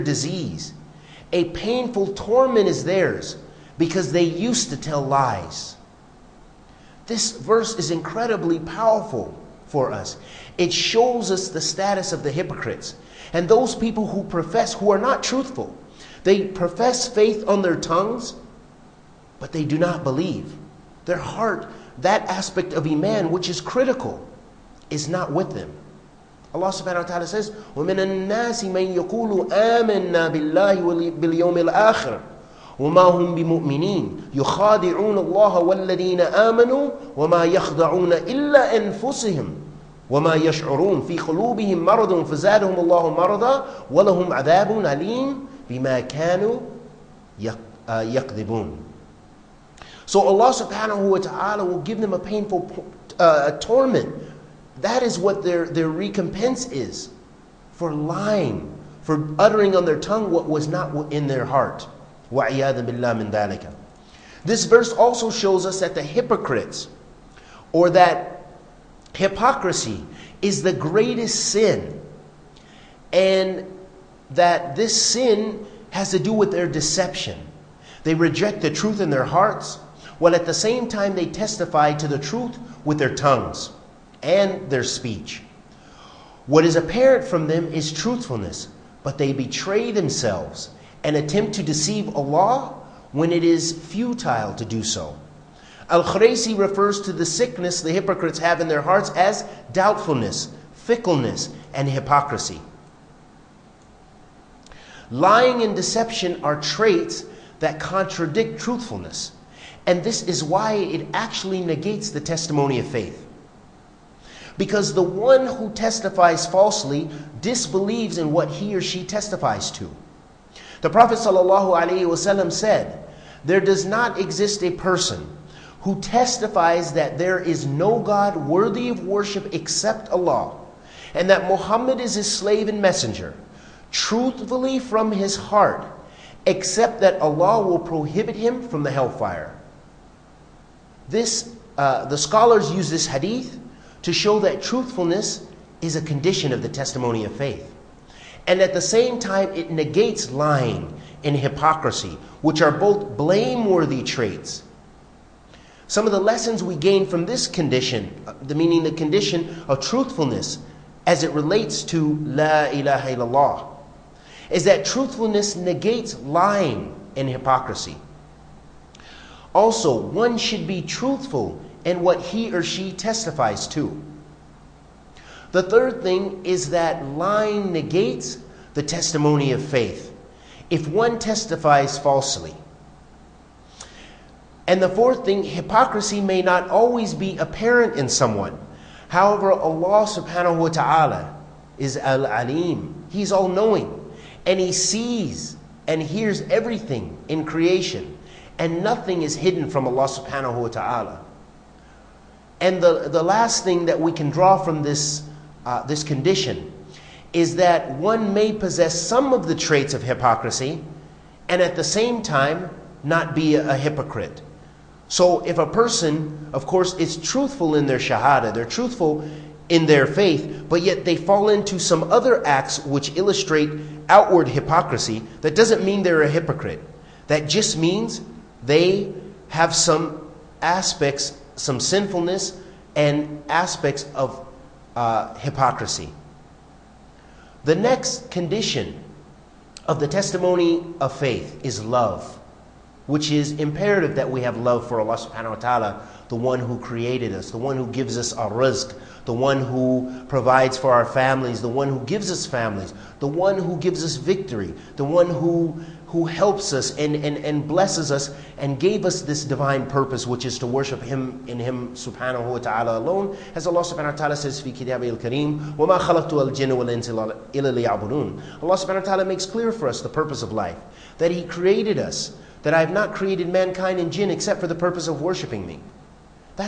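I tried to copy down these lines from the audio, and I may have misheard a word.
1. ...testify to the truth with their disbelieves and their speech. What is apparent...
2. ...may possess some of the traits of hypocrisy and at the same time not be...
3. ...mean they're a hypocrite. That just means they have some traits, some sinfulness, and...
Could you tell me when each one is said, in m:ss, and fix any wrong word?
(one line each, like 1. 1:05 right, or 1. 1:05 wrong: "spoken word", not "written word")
1. 1:21 wrong: "tongues", not "disbelieves"
2. 3:28 right
3. 3:45 wrong: "aspects", not "traits".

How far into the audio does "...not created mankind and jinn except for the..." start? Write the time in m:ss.
4:32.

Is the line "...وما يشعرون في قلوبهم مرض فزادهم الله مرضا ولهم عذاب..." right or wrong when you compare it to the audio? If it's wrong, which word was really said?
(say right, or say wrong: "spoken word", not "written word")
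right.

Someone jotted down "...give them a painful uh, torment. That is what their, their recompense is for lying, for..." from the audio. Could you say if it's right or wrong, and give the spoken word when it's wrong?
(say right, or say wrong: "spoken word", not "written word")
right.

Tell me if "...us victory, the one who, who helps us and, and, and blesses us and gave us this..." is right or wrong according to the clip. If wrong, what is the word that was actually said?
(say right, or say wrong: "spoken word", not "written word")
right.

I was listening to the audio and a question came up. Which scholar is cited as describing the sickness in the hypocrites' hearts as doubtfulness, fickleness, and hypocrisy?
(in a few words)
Al Khraisi.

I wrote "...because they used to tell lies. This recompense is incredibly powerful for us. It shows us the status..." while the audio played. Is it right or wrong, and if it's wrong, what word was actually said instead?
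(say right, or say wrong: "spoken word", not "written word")
wrong: "verse", not "recompense".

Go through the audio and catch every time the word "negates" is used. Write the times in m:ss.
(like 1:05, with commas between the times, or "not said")
1:51, 2:29, 2:45, 2:57.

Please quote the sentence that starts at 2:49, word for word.
Also, one should be truthful in what he or she testifies to.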